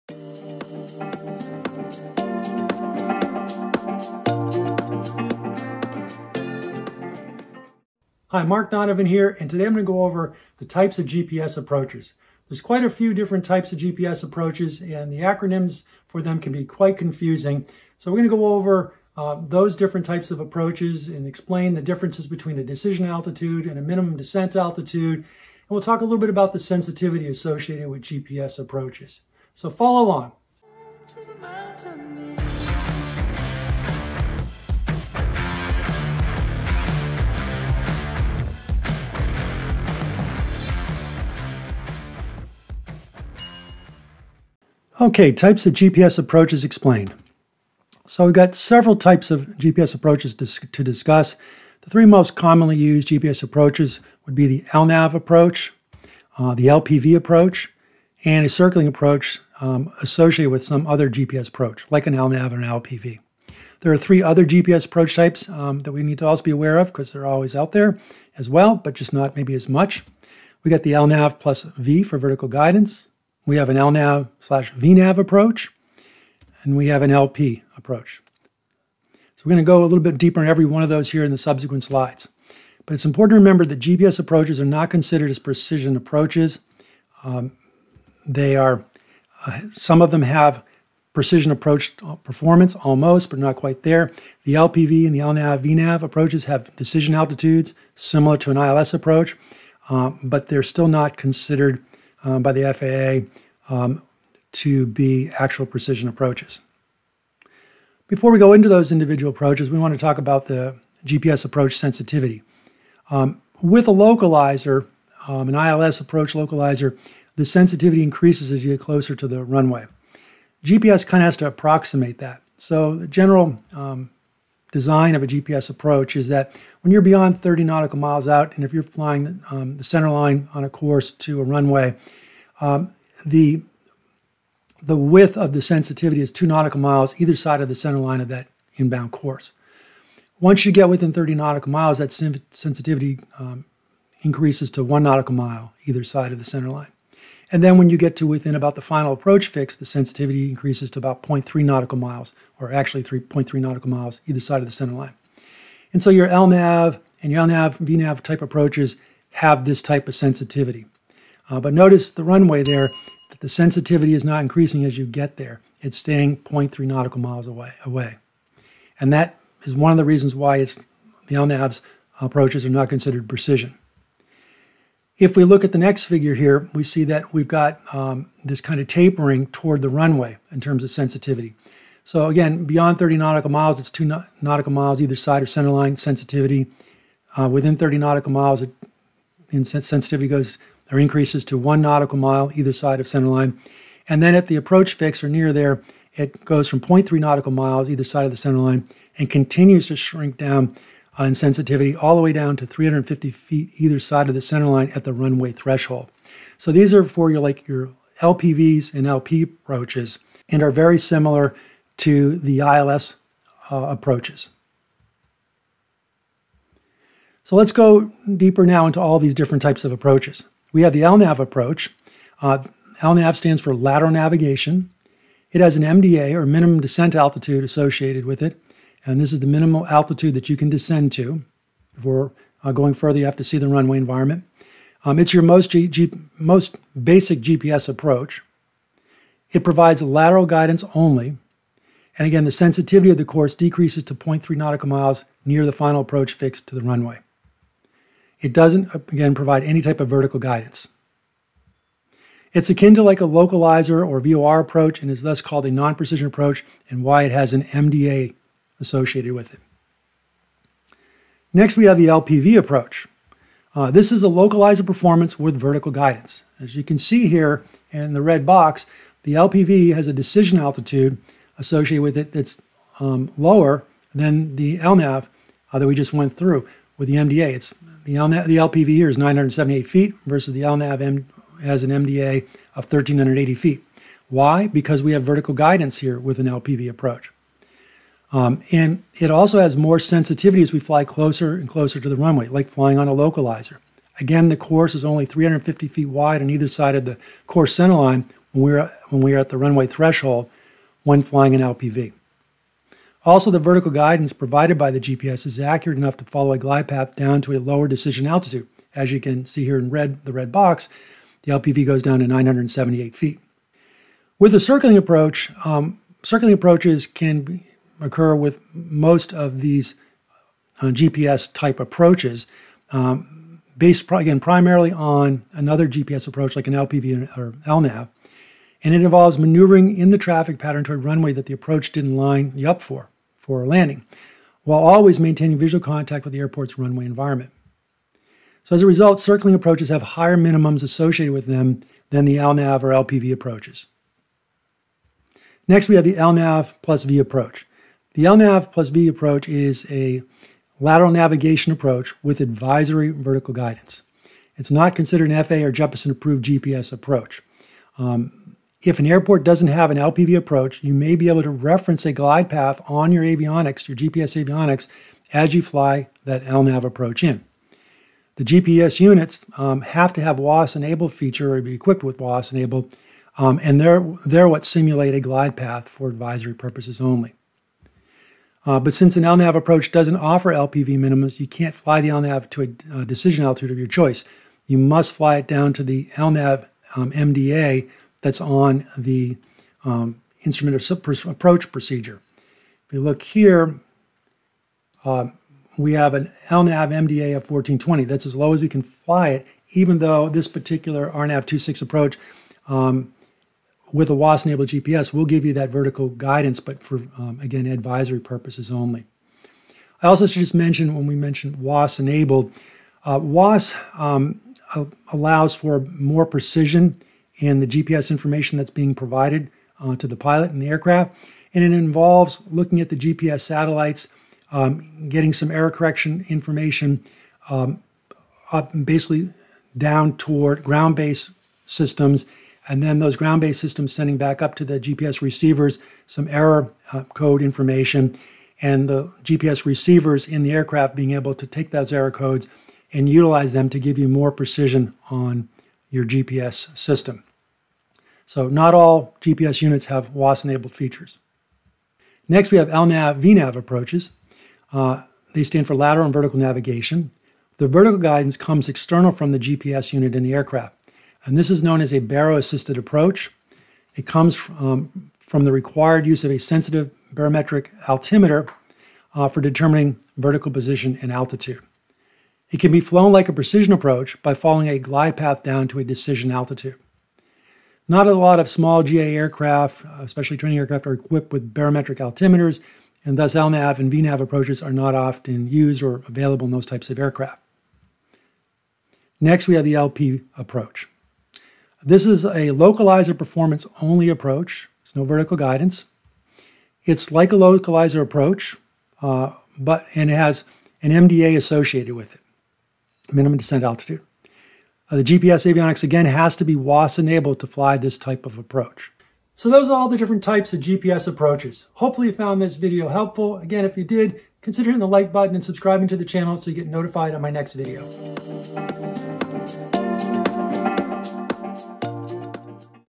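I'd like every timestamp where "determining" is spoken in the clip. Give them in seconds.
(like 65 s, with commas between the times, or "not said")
469 s.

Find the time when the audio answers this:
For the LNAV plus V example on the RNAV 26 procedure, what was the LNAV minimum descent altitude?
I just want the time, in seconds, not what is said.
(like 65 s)
397 s.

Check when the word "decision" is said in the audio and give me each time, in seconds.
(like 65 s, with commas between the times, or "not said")
22 s, 96 s, 270 s, 307 s, 383 s, 475 s.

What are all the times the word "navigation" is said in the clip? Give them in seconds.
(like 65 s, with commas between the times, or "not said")
224 s, 351 s, 456 s.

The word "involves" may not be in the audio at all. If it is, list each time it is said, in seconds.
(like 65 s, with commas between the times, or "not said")
329 s, 421 s.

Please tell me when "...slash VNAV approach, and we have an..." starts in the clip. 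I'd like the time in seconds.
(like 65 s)
74 s.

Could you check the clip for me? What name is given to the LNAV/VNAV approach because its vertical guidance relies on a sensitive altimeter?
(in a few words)
baro-assisted approach.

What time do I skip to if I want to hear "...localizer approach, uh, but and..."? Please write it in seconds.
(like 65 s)
497 s.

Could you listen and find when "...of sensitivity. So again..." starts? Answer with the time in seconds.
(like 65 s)
180 s.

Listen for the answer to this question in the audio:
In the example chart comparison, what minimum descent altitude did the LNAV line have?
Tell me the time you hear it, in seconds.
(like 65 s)
282 s.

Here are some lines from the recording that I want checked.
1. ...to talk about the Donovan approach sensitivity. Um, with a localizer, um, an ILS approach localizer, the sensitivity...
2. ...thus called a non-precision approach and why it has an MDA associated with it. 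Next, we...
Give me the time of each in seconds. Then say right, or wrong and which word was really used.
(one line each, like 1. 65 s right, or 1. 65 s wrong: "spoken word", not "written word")
1. 109 s wrong: "GPS", not "Donovan"
2. 255 s right.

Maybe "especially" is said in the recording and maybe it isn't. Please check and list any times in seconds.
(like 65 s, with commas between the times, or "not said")
480 s.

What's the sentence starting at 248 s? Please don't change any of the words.
It doesn't, uh, again, provide any type of vertical guidance.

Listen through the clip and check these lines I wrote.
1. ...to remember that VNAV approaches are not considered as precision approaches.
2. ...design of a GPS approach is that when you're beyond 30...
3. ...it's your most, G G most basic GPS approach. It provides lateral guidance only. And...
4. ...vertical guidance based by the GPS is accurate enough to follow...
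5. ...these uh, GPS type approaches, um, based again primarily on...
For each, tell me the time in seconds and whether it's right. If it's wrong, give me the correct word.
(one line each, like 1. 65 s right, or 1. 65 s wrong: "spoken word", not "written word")
1. 83 s wrong: "GPS", not "VNAV"
2. 124 s right
3. 235 s right
4. 303 s wrong: "provided", not "based"
5. 319 s right.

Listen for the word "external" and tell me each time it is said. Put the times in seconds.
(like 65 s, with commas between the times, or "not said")
458 s.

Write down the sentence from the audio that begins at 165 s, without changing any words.
It's staying 0.3 nautical miles away.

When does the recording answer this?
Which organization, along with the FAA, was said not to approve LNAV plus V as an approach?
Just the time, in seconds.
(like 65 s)
355 s.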